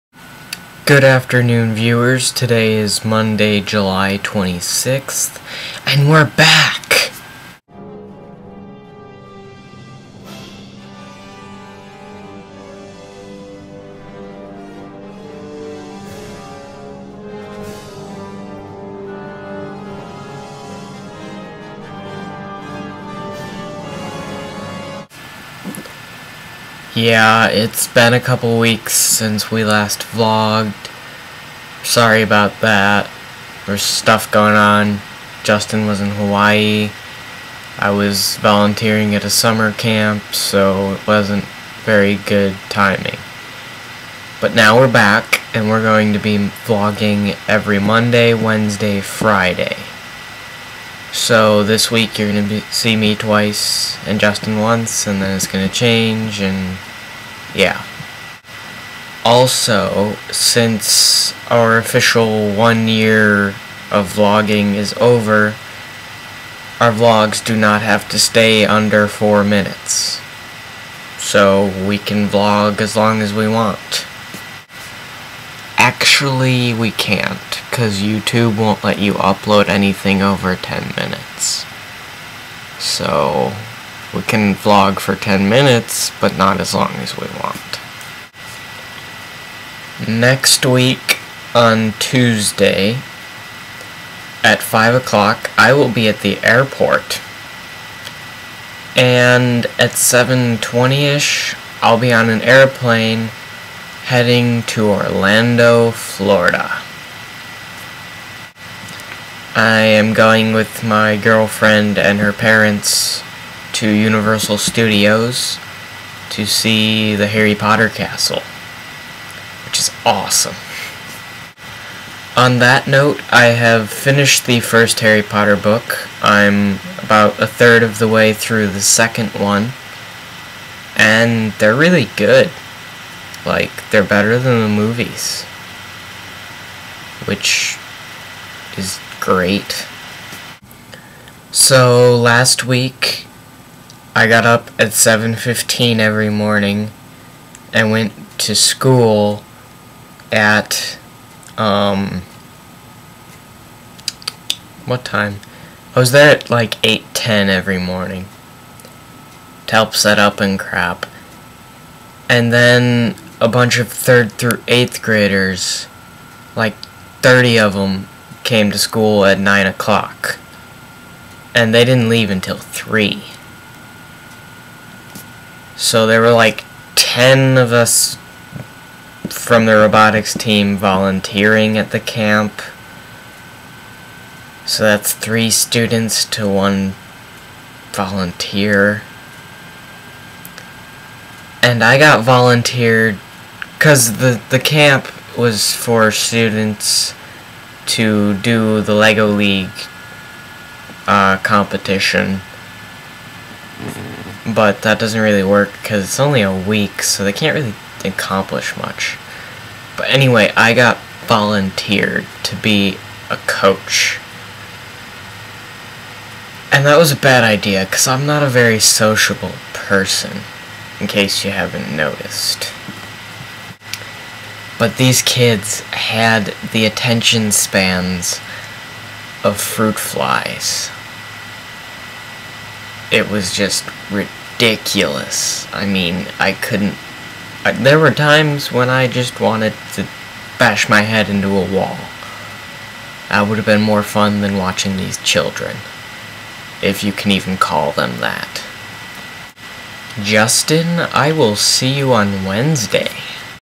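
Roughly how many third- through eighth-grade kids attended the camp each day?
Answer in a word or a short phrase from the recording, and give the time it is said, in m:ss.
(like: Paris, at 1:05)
30, at 2:47.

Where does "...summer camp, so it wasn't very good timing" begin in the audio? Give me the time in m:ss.
0:39.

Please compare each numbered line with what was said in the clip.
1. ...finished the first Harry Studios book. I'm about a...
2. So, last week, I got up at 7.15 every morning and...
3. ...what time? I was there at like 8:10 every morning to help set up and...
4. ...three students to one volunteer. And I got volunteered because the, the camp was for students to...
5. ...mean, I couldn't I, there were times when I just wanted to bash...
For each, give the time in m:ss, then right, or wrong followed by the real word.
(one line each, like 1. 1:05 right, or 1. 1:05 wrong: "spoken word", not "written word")
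1. 2:03 wrong: "Potter", not "Studios"
2. 2:21 right
3. 2:34 right
4. 3:05 right
5. 3:55 right.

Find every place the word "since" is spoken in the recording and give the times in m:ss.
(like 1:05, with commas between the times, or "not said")
0:28, 1:00.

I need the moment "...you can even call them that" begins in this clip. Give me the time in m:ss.
4:07.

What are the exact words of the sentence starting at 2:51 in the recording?
And they didn't leave until 3.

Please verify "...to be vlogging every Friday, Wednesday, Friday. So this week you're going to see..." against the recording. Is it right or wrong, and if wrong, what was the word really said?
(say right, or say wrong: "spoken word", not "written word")
wrong: "Monday", not "Friday".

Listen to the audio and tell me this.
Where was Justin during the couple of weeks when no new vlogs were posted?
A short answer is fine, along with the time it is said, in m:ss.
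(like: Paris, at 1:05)
Hawaii, at 0:36.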